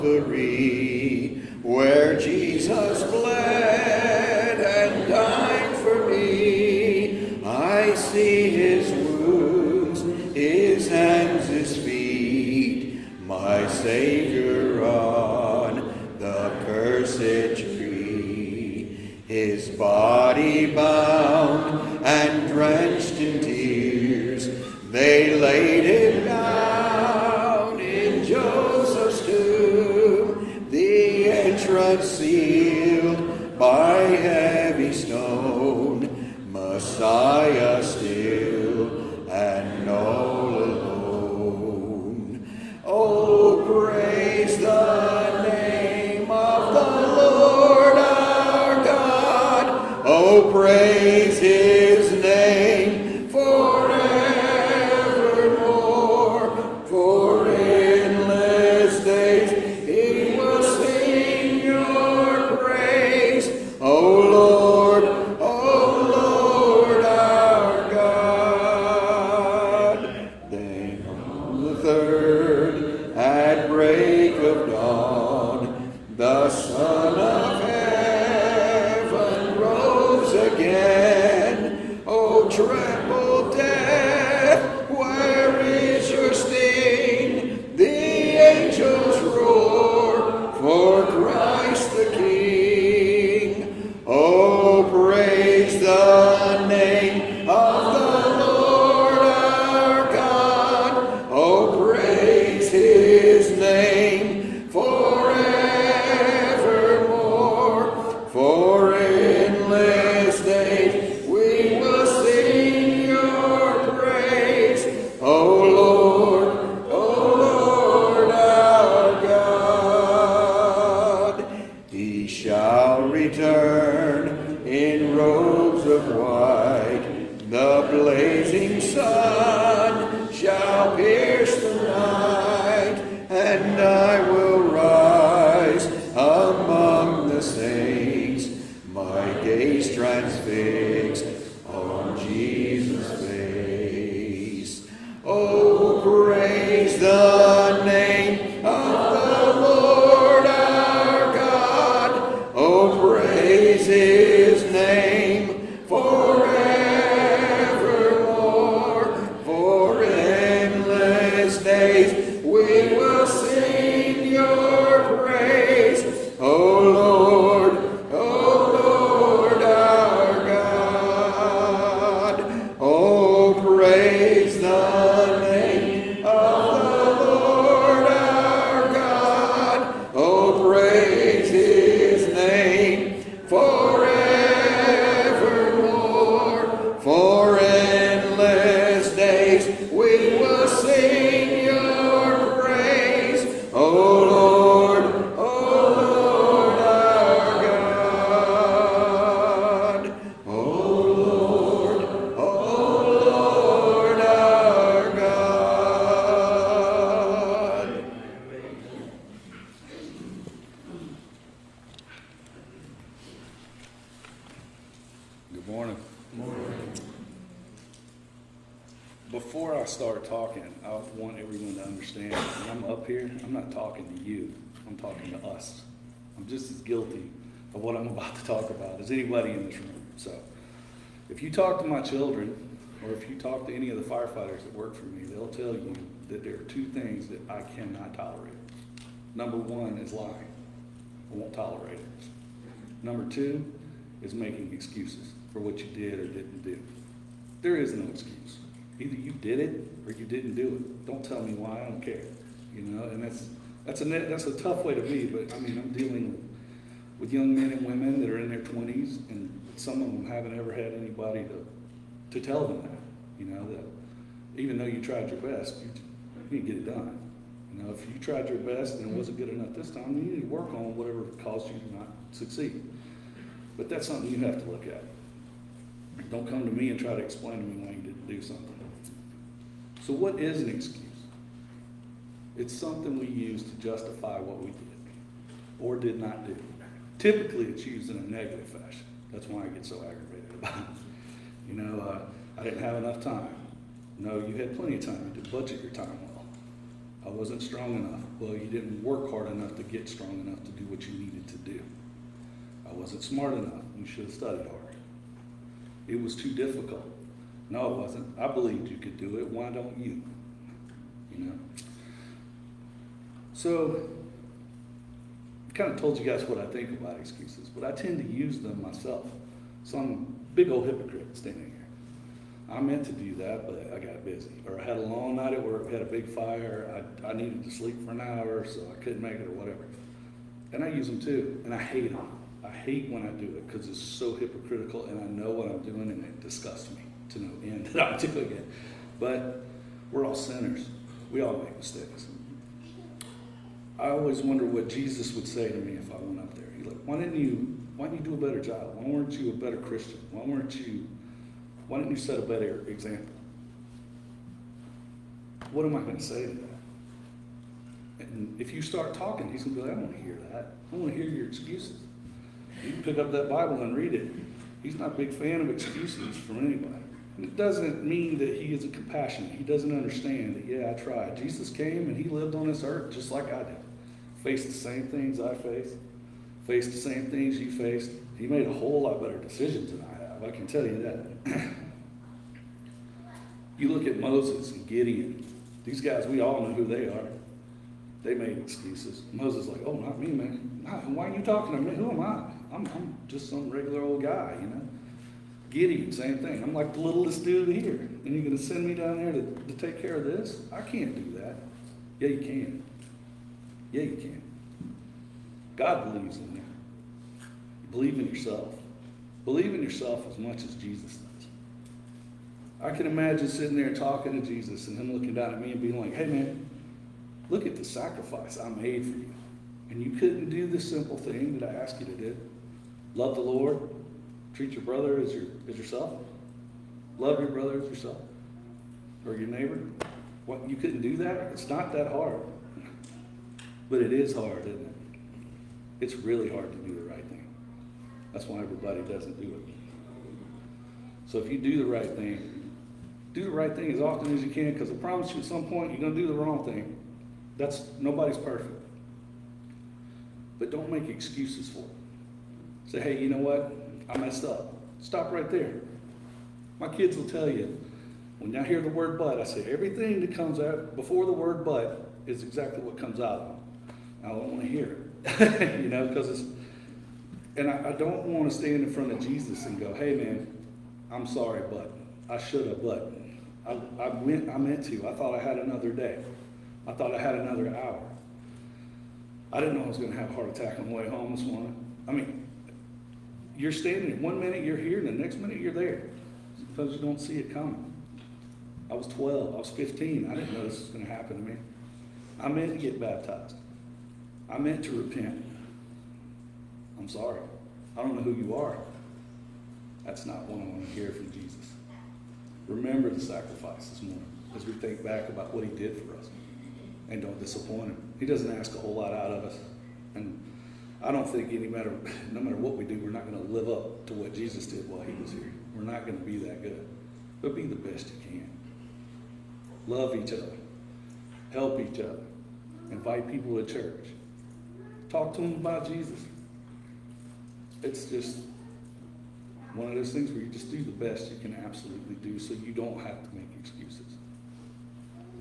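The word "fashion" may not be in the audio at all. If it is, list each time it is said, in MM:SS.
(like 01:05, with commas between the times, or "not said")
04:48.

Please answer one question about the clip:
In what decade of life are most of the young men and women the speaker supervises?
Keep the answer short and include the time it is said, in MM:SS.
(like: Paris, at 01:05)
Their 20s, at 04:18.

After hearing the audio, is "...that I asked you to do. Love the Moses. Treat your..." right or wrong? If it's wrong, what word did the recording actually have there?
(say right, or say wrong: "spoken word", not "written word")
wrong: "Lord", not "Moses".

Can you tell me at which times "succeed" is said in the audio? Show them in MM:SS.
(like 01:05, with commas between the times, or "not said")
04:32.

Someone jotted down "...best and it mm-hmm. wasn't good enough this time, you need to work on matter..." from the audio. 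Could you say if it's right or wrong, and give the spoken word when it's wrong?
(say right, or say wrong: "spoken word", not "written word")
wrong: "whatever", not "matter".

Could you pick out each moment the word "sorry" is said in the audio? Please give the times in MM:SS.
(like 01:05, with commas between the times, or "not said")
07:51, 08:17.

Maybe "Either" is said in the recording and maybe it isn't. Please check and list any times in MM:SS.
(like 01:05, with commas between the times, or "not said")
04:08.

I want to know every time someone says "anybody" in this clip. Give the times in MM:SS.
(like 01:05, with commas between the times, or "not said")
04:20, 06:06.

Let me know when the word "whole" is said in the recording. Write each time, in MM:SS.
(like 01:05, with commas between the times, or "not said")
06:18, 08:28.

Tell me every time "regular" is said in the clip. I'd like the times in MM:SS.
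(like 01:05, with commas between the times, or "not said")
06:33.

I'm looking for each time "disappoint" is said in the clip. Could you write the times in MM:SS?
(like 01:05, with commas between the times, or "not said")
08:27.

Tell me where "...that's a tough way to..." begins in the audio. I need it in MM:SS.
04:14.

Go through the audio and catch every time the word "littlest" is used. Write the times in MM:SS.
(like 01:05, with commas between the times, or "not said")
06:37.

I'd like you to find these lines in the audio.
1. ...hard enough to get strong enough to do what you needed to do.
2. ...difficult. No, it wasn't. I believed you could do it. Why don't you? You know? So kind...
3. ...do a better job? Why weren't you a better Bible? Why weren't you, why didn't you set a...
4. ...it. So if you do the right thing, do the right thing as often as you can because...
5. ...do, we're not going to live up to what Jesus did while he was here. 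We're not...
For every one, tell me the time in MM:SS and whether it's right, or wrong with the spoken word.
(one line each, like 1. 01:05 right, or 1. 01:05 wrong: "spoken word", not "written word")
1. 04:59 right
2. 05:06 right
3. 05:48 wrong: "Christian", not "Bible"
4. 07:19 right
5. 08:32 right.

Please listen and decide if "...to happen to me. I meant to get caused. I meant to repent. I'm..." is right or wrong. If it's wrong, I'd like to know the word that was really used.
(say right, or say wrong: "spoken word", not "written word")
wrong: "baptized", not "caused".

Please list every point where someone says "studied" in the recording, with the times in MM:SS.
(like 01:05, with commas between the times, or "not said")
05:04.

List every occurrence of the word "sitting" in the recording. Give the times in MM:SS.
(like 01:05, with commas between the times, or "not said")
06:53.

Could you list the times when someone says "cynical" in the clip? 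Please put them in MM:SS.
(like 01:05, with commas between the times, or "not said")
not said.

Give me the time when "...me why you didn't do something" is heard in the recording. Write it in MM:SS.
04:37.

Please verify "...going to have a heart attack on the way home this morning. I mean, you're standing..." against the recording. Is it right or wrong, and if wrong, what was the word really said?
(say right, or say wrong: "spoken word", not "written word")
right.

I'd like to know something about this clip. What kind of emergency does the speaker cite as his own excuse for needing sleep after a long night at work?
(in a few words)
A big fire.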